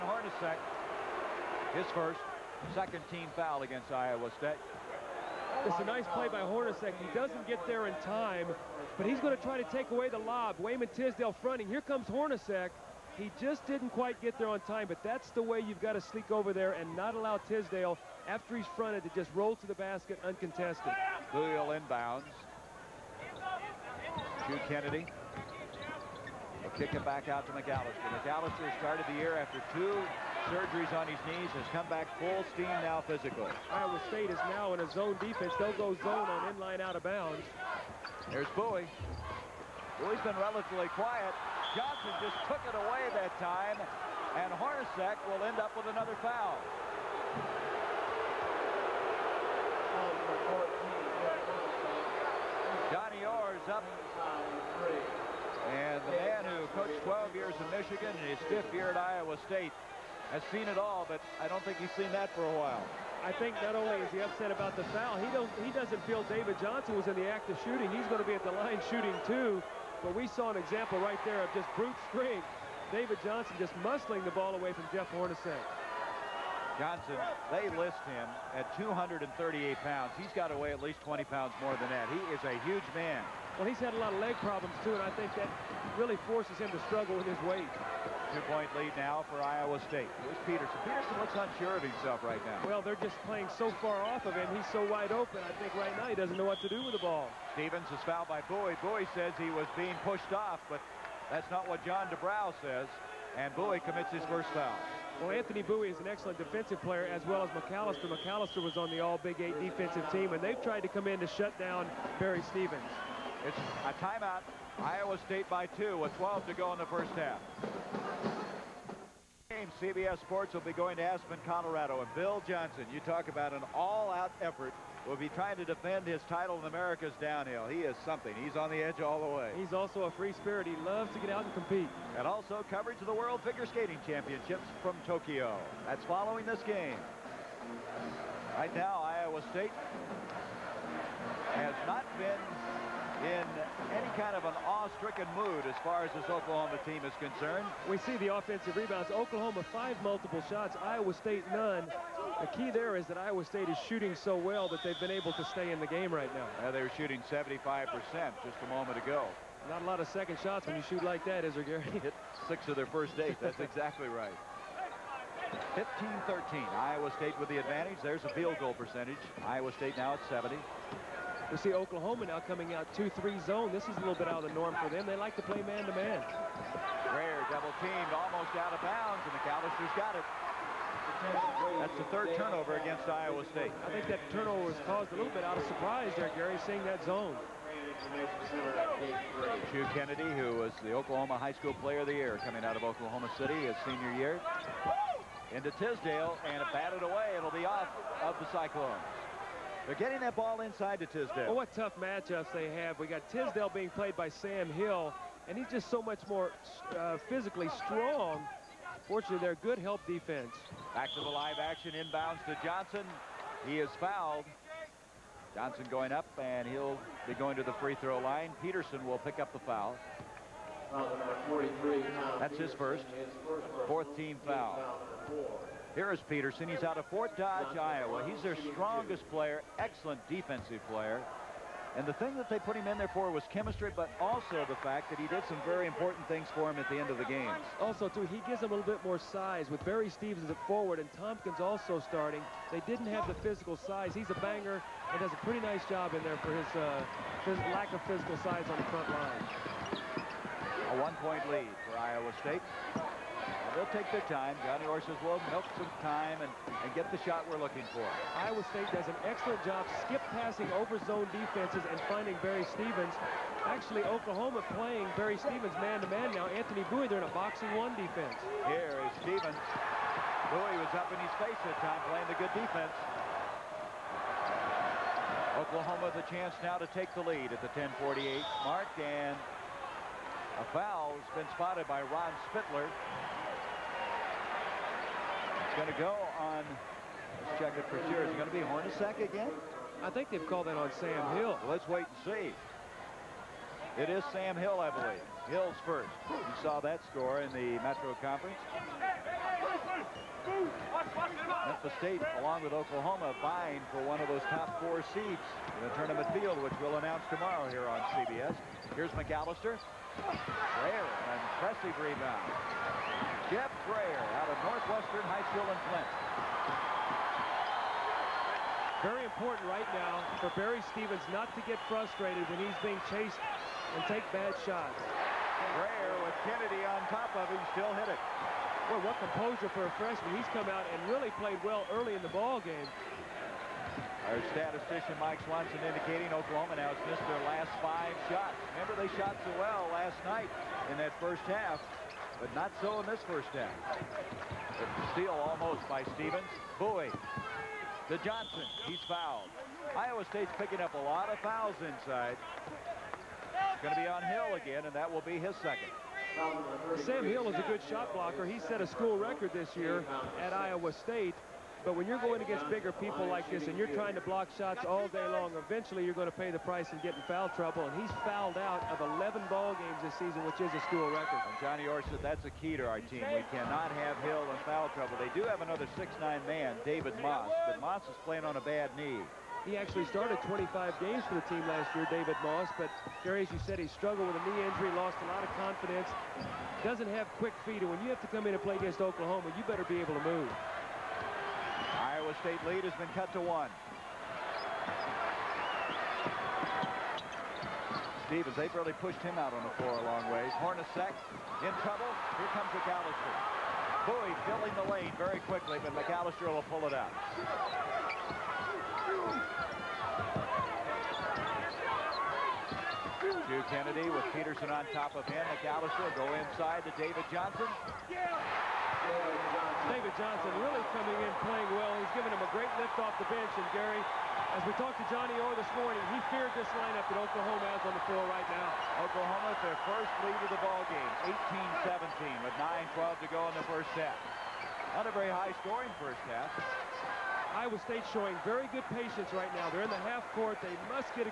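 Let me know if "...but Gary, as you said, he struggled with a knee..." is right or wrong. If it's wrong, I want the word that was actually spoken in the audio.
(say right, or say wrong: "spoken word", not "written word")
wrong: "Jerry", not "Gary".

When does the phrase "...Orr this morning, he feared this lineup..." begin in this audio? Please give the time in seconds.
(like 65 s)
425 s.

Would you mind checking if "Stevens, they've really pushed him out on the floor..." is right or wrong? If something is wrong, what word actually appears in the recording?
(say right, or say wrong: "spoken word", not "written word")
right.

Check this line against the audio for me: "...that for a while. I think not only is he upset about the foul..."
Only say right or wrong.
right.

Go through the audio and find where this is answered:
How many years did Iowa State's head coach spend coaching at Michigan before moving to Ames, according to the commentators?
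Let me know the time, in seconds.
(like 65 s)
57 s.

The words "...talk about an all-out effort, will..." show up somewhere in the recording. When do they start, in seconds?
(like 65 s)
123 s.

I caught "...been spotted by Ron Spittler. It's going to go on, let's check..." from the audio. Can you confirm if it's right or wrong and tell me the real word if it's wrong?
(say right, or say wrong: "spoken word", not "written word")
right.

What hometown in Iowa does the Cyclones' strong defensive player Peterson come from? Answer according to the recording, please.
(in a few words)
Fort Dodge.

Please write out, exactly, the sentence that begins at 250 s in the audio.
A one-point lead for Iowa State.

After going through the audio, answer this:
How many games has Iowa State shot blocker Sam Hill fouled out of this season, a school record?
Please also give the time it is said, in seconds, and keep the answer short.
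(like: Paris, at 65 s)
11, at 369 s.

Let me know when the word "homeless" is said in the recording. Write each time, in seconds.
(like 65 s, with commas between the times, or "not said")
not said.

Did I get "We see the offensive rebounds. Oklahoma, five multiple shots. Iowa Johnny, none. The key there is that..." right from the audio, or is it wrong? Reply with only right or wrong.
wrong.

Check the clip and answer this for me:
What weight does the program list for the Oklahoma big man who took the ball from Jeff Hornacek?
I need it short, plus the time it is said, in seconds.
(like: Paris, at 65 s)
238 pounds, at 78 s.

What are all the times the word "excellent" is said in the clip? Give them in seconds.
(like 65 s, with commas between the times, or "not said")
106 s, 229 s, 259 s.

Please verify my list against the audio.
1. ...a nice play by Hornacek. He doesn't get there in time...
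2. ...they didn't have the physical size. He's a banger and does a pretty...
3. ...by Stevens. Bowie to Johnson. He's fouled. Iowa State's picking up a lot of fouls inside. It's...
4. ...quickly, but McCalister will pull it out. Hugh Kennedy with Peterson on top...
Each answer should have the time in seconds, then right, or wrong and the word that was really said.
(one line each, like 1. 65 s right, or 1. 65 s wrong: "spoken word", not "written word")
1. 5 s right
2. 242 s right
3. 345 s right
4. 405 s right.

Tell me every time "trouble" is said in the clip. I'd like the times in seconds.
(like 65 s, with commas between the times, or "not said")
367 s, 374 s, 401 s.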